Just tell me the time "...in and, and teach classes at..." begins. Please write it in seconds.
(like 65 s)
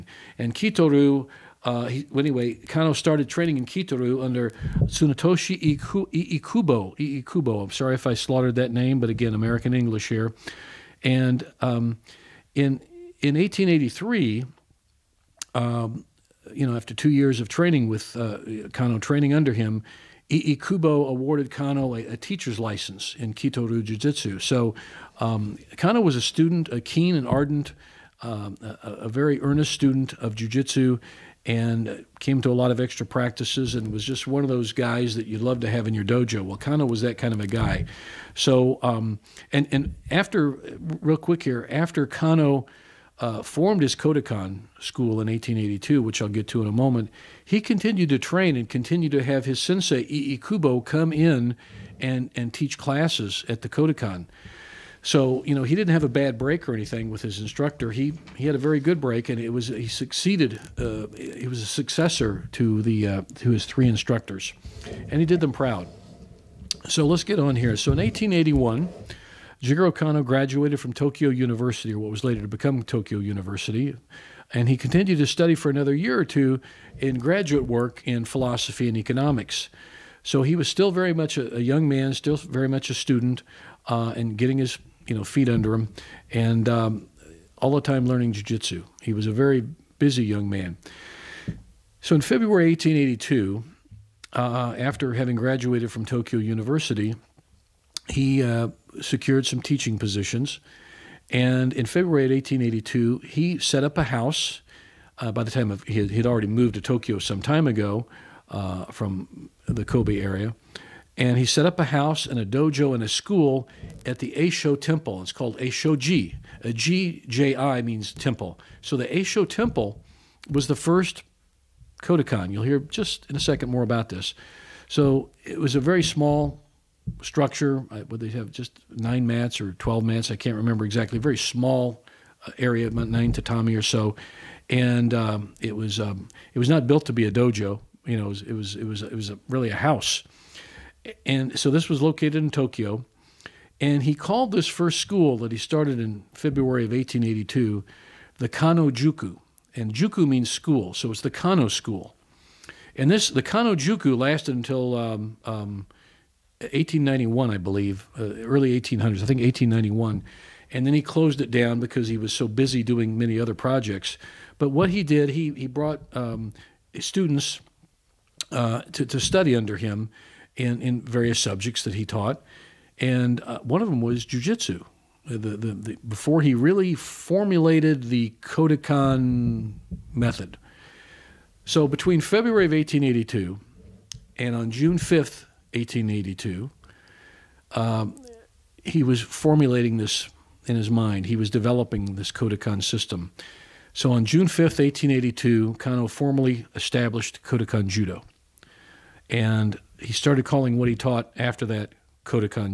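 51 s.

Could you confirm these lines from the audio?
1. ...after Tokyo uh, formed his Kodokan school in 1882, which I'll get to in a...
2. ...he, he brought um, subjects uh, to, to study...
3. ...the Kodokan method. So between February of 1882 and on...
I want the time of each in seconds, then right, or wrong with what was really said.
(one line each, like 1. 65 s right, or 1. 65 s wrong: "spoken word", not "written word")
1. 41 s wrong: "Kano", not "Tokyo"
2. 165 s wrong: "students", not "subjects"
3. 178 s right.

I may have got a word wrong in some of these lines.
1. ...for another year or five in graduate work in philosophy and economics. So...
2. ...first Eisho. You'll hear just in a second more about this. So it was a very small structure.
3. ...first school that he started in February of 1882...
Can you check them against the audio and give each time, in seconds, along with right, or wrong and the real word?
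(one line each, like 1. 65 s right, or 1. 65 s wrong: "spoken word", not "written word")
1. 75 s wrong: "two", not "five"
2. 120 s wrong: "Kodokan", not "Eisho"
3. 144 s right.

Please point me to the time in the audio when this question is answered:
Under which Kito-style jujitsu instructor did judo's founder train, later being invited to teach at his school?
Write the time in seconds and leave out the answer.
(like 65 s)
4 s.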